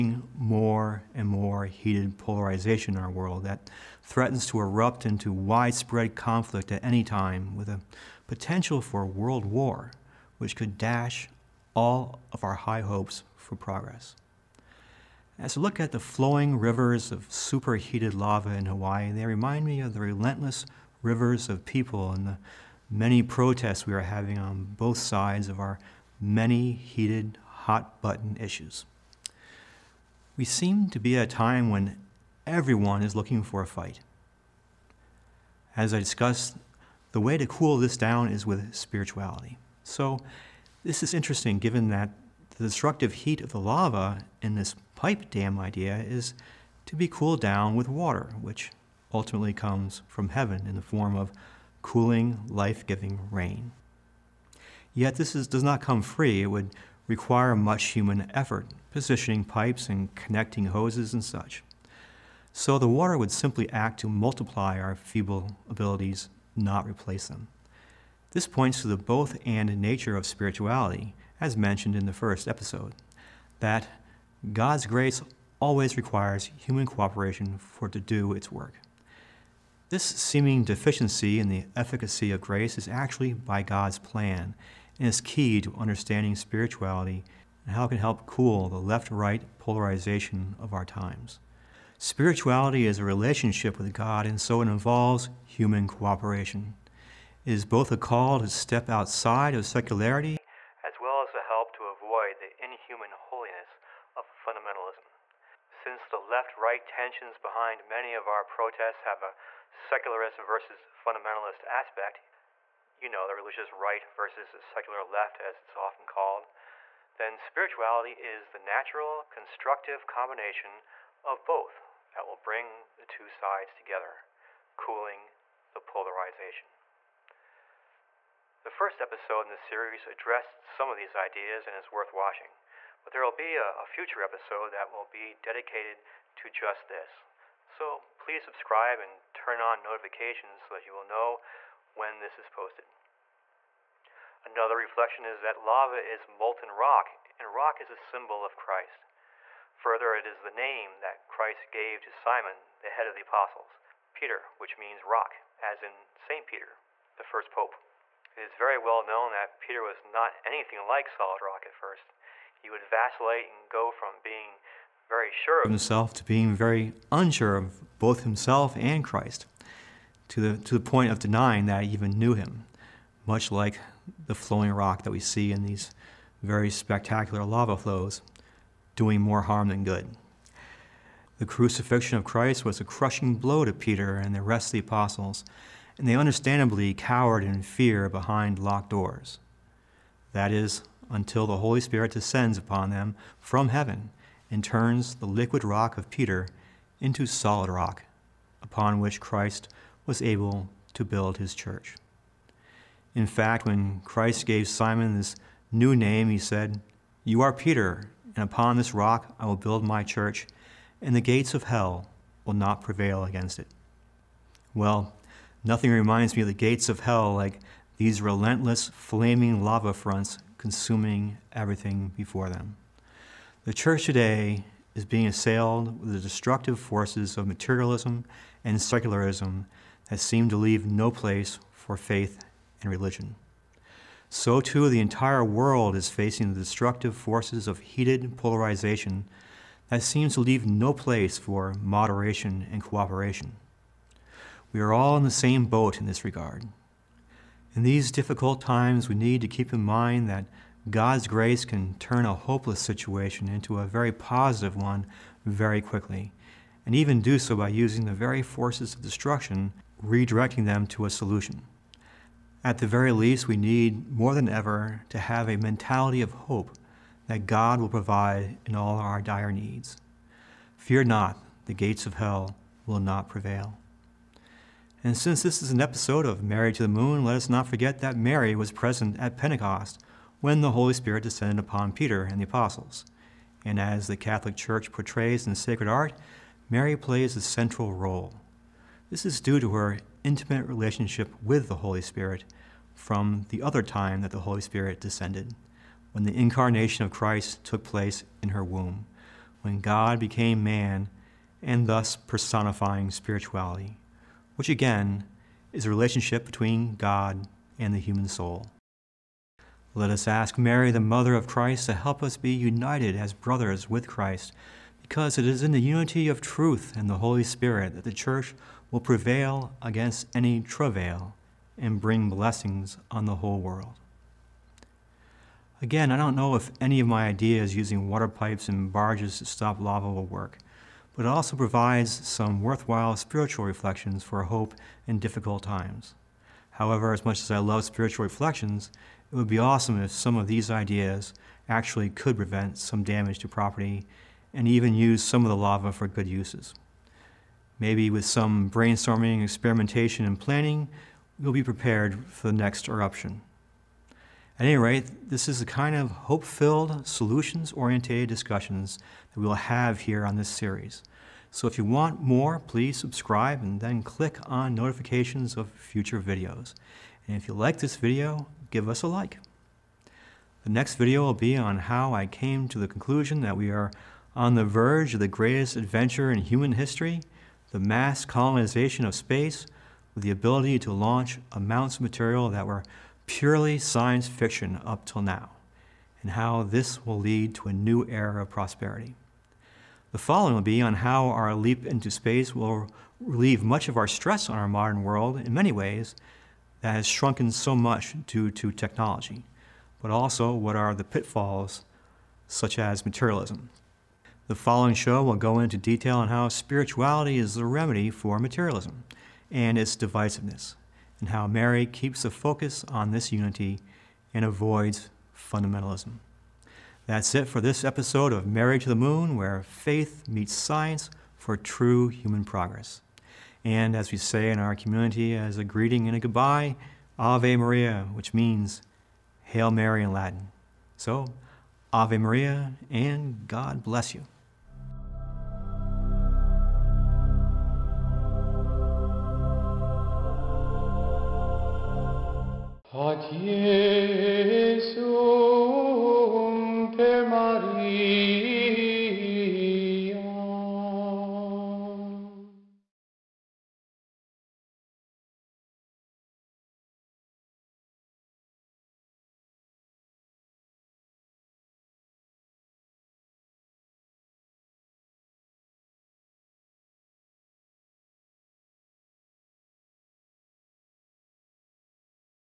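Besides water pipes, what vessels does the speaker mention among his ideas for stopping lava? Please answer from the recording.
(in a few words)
barges.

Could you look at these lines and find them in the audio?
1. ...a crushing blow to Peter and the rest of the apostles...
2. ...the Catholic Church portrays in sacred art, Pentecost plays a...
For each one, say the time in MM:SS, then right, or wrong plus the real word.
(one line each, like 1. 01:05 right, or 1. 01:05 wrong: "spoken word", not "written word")
1. 03:02 right
2. 04:44 wrong: "Mary", not "Pentecost".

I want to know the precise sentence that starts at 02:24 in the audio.
Another reflection is that lava is molten rock, and rock is a symbol of Christ.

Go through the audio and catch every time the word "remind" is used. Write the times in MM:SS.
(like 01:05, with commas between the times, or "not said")
00:19, 03:35.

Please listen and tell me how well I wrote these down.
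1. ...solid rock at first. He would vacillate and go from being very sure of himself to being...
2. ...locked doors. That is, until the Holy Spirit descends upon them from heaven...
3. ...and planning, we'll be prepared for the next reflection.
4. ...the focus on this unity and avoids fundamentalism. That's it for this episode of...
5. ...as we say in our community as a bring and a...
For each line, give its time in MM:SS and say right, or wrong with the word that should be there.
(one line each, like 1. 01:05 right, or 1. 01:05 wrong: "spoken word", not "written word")
1. 02:41 right
2. 03:08 right
3. 05:50 wrong: "eruption", not "reflection"
4. 06:52 right
5. 07:03 wrong: "greeting", not "bring".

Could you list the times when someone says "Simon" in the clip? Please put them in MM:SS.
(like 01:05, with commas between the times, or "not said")
02:32, 03:24.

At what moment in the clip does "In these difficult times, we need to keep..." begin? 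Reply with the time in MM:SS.
04:07.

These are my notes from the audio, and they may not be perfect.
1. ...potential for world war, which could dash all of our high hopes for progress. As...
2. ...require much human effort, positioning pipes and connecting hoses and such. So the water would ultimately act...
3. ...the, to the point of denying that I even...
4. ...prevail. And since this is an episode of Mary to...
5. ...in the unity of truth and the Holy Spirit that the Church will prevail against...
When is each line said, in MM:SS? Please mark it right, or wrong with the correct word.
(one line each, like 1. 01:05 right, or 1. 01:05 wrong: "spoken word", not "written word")
1. 00:08 right
2. 00:57 wrong: "simply", not "ultimately"
3. 02:50 right
4. 04:33 right
5. 05:15 right.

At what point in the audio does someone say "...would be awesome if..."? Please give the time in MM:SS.
05:39.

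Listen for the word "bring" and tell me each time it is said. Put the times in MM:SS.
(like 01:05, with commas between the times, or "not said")
02:02, 05:22.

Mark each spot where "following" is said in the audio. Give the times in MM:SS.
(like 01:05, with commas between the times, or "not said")
06:30, 06:44.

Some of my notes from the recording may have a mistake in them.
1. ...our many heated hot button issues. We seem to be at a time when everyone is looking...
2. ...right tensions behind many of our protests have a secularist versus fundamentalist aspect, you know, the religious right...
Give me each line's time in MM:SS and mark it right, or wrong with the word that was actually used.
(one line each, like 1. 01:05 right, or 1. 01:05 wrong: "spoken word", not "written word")
1. 00:25 right
2. 01:46 right.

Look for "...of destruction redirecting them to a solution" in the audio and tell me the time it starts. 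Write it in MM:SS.
04:18.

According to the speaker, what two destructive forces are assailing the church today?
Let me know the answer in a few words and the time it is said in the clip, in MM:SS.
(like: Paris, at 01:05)
materialism and secularism, at 03:47.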